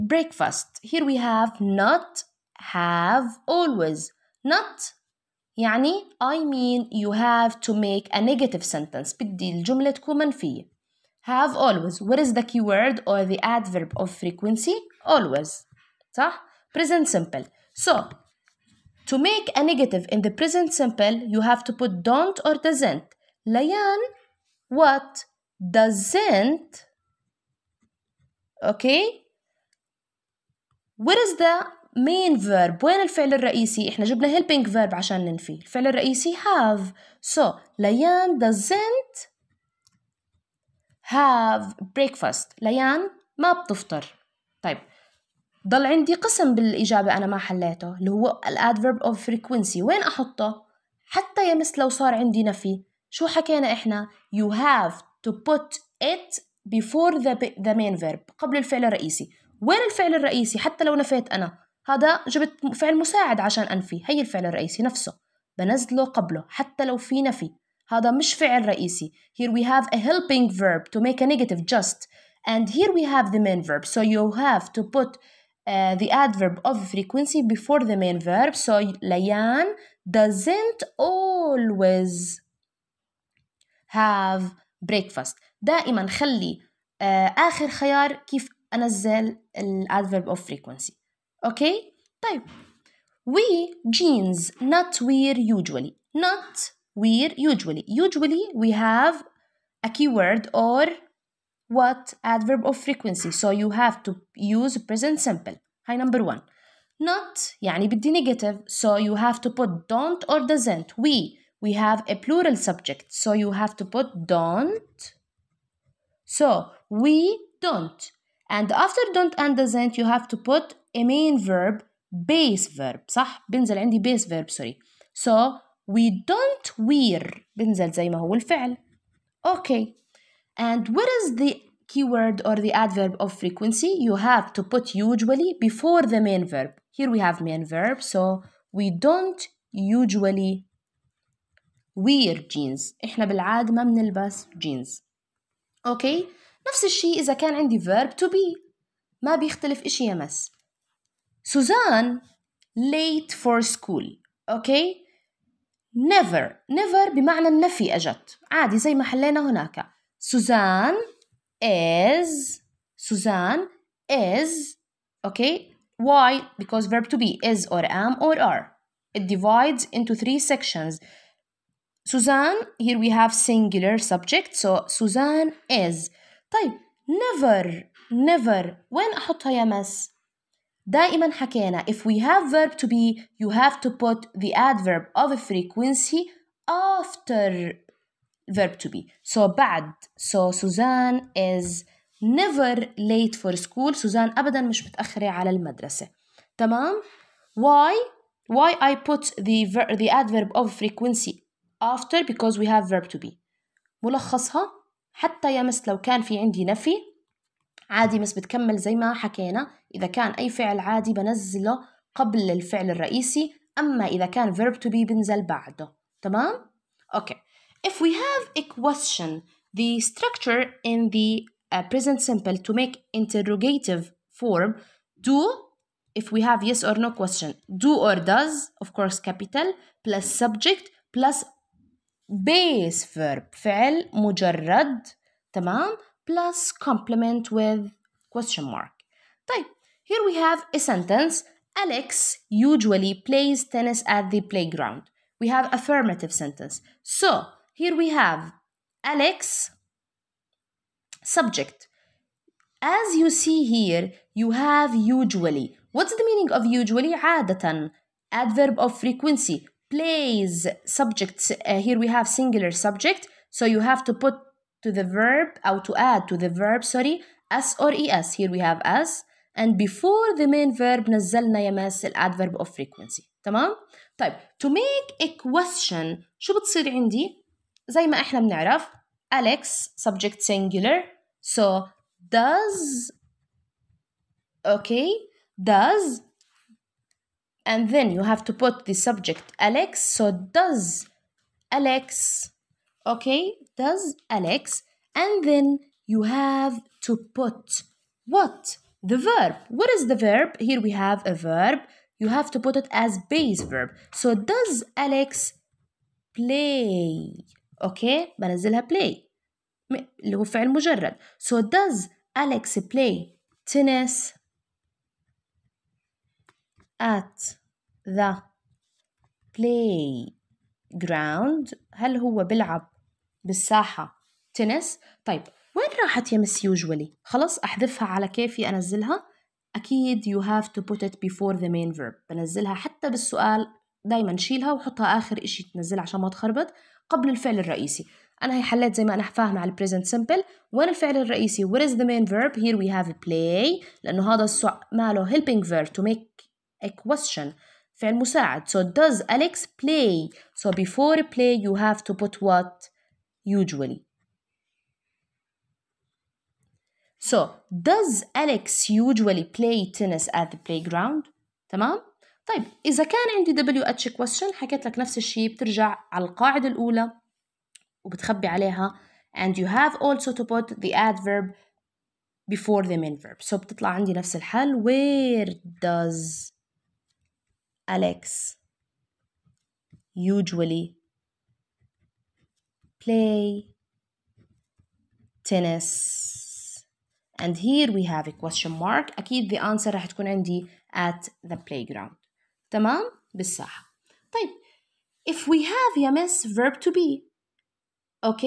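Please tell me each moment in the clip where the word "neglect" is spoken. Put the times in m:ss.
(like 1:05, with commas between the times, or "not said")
not said.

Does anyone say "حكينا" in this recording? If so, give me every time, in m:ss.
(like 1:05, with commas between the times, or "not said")
0:53, 3:01, 3:29.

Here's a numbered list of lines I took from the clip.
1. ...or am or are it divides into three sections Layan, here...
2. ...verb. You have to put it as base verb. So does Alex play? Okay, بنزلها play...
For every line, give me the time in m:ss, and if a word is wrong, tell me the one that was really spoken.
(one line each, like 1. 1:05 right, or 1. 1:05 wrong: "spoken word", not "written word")
1. 2:47 wrong: "Suzanne", not "Layan"
2. 5:01 right.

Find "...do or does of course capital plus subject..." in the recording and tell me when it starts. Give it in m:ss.
3:47.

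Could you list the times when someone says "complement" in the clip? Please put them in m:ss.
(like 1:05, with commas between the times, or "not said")
3:56.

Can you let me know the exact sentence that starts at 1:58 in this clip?
And after don't and doesn't, you have to put a main verb, base verb.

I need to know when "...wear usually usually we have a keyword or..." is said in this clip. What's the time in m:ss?
1:37.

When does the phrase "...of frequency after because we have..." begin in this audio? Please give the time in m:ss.
3:20.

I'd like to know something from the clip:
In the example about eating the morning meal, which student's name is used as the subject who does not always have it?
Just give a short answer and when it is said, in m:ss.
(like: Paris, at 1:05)
Layan, at 0:37.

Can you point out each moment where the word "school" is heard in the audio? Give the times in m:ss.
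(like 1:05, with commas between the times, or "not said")
2:33, 3:13.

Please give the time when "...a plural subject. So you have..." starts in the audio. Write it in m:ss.
1:52.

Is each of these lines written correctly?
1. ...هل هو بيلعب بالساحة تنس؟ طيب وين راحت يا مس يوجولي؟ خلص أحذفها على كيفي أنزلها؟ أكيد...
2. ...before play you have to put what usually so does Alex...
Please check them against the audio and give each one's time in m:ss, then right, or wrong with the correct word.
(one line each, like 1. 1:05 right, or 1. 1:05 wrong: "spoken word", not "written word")
1. 5:21 right
2. 5:50 right.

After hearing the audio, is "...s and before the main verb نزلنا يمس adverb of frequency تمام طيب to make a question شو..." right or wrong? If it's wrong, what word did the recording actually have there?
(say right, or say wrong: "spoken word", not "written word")
right.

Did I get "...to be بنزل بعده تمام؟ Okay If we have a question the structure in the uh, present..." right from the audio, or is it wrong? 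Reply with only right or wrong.
right.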